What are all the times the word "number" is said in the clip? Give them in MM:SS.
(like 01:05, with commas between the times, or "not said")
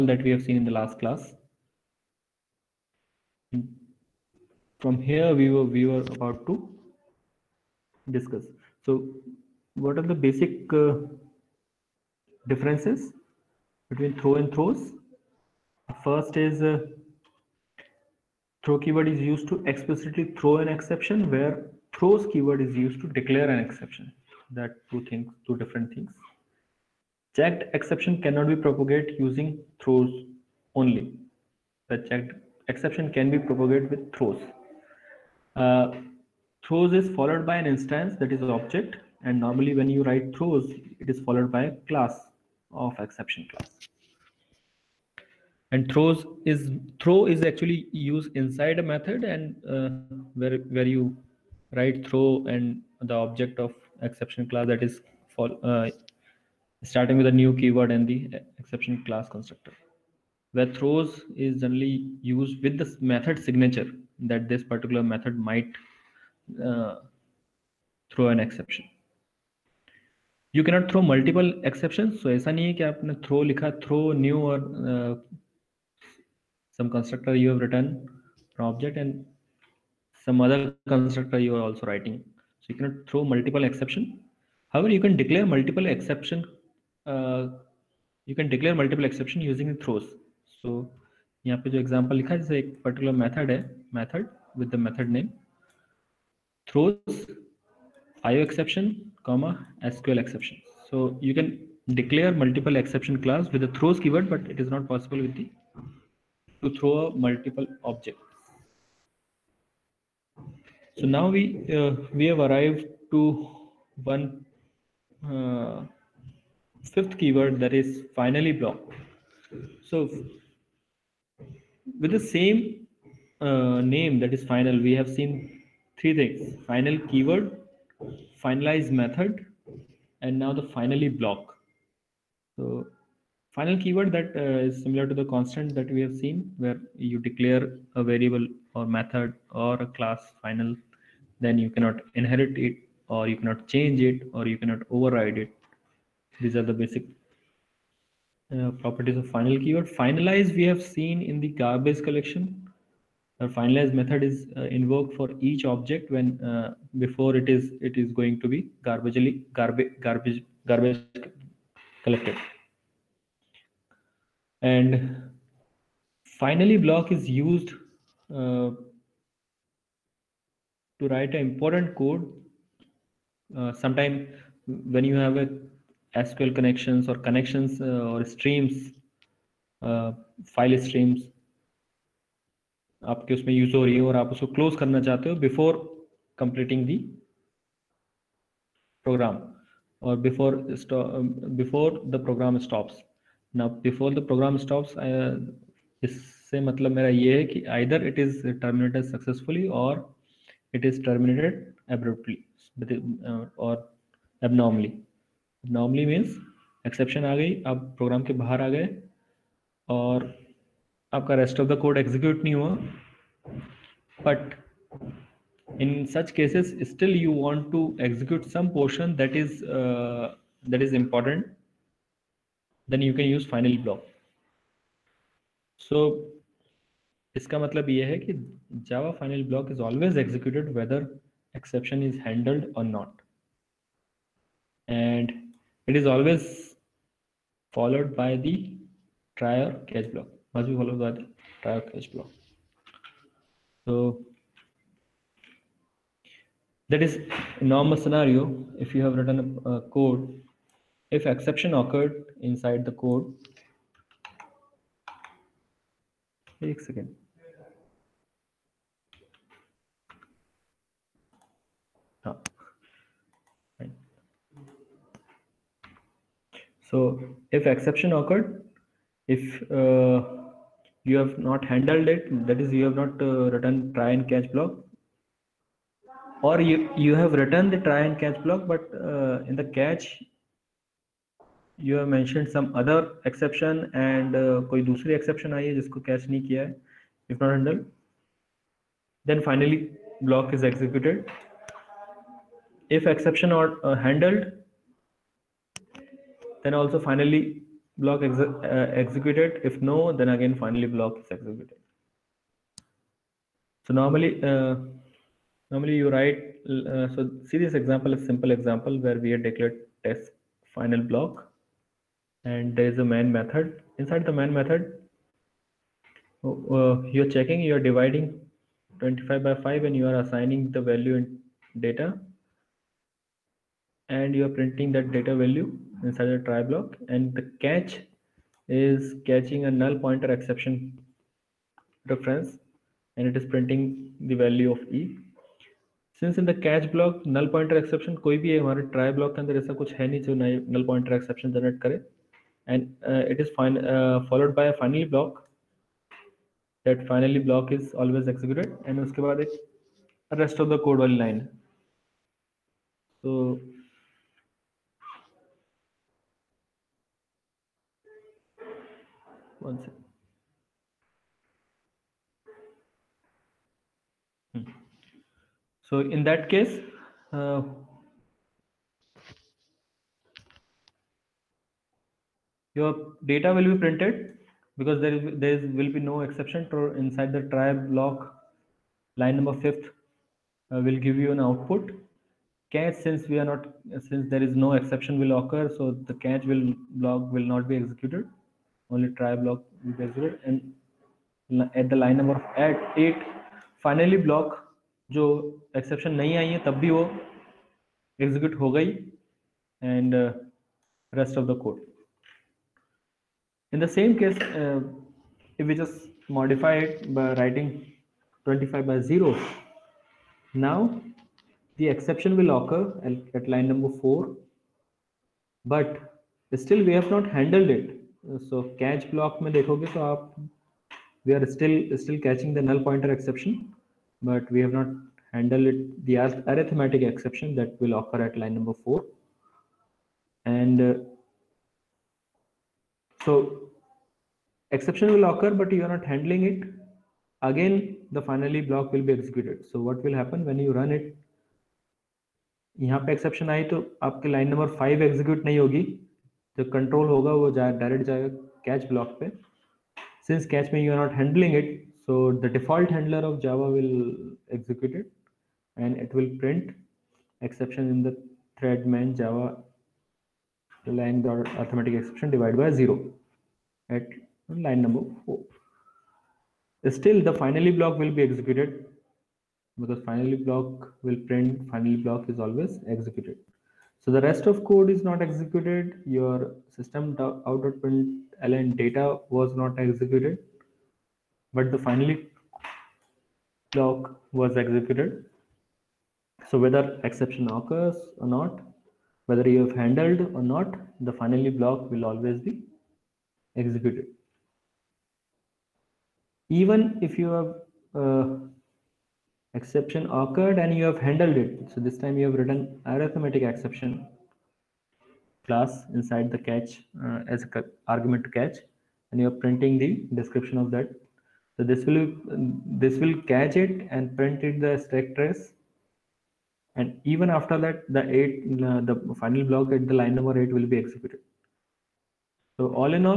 06:19, 06:32, 06:53, 07:08, 07:44, 08:40.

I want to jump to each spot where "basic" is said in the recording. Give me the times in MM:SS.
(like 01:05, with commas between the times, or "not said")
00:10, 02:26.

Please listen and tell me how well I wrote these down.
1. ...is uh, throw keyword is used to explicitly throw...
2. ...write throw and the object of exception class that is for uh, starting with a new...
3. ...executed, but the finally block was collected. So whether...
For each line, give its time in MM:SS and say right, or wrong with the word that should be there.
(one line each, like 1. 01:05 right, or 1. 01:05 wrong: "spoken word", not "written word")
1. 00:16 right
2. 00:51 right
3. 07:59 wrong: "executed", not "collected".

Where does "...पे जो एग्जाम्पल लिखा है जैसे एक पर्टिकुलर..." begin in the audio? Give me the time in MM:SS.
01:31.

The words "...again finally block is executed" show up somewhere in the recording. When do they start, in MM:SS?
05:00.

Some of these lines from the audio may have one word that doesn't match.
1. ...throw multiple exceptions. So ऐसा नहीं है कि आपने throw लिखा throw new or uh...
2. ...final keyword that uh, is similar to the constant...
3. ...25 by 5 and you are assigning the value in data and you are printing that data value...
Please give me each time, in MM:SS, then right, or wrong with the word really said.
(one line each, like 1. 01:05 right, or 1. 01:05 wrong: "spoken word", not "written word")
1. 01:10 right
2. 02:13 right
3. 05:19 right.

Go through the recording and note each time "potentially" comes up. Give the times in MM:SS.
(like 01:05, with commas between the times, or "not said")
not said.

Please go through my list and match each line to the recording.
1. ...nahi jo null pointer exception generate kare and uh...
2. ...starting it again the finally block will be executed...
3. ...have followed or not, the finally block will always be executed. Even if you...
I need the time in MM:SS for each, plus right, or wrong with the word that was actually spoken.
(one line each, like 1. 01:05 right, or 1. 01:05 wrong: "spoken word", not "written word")
1. 05:40 right
2. 07:16 wrong: "handling", not "starting"
3. 08:09 wrong: "handled", not "followed".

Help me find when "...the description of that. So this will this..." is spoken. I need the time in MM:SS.
08:29.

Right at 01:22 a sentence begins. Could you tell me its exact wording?
So you cannot throw multiple exception.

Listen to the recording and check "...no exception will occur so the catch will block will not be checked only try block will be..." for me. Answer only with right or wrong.
wrong.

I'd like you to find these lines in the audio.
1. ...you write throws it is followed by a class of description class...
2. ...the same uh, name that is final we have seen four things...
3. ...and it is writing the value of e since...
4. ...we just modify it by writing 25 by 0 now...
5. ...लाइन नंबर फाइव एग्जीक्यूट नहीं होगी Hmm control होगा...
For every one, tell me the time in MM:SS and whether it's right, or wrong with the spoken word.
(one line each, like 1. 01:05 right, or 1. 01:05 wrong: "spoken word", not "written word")
1. 00:39 wrong: "exception", not "description"
2. 02:02 wrong: "three", not "four"
3. 05:33 wrong: "printing", not "writing"
4. 06:45 right
5. 07:24 wrong: "The", not "Hmm".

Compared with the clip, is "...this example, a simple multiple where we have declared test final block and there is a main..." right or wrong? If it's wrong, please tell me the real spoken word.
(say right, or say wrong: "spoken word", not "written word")
wrong: "example", not "multiple".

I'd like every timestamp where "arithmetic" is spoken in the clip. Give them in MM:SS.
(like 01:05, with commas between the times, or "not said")
07:06, 07:41, 08:22.